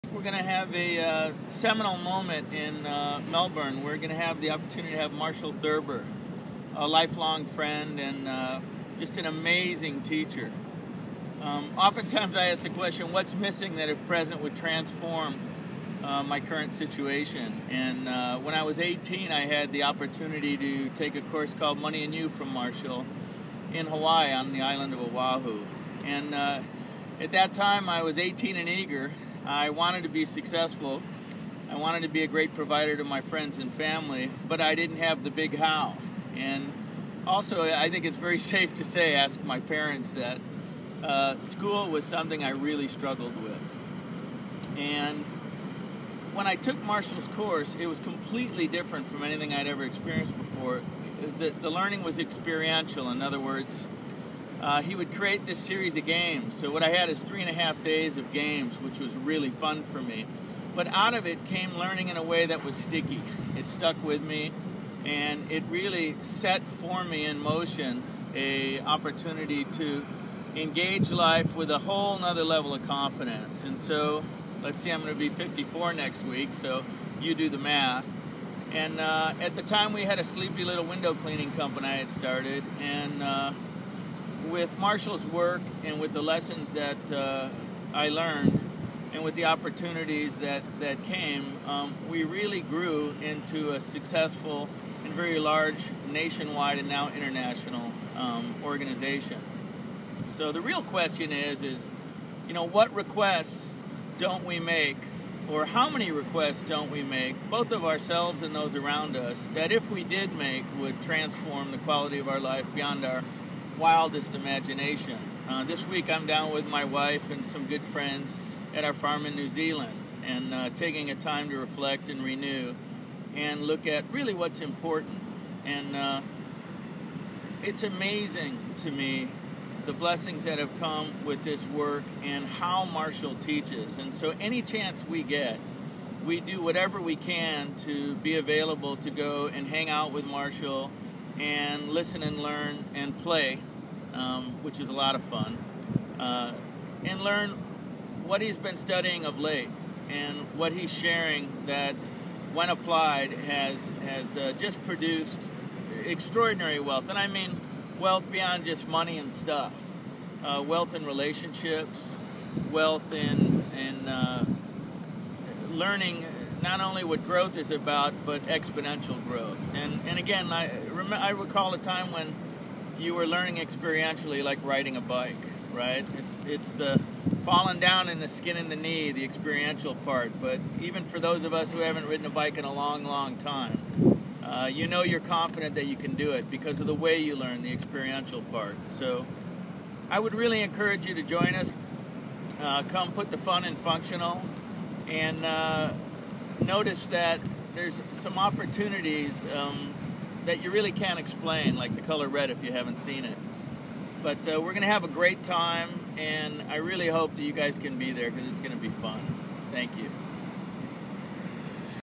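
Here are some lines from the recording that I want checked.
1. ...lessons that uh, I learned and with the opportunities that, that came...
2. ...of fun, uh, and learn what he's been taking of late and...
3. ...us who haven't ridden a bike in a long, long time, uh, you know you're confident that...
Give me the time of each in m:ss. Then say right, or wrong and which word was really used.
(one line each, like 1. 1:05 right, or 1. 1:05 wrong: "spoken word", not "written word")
1. 1:26 right
2. 2:25 wrong: "studying", not "taking"
3. 3:01 right.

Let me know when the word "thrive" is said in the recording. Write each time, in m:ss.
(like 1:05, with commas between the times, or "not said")
not said.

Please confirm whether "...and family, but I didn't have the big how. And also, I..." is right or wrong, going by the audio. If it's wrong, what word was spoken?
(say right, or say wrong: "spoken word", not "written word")
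right.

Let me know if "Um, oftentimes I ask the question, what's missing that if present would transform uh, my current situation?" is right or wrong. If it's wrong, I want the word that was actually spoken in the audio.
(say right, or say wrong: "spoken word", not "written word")
right.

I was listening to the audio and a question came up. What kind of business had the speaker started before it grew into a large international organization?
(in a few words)
window cleaning company.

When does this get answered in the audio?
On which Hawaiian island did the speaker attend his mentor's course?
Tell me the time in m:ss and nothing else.
0:25.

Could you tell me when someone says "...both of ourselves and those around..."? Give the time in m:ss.
1:47.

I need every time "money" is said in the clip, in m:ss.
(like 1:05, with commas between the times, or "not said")
0:21, 2:38.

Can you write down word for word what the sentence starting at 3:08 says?
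So I would really encourage you to join us.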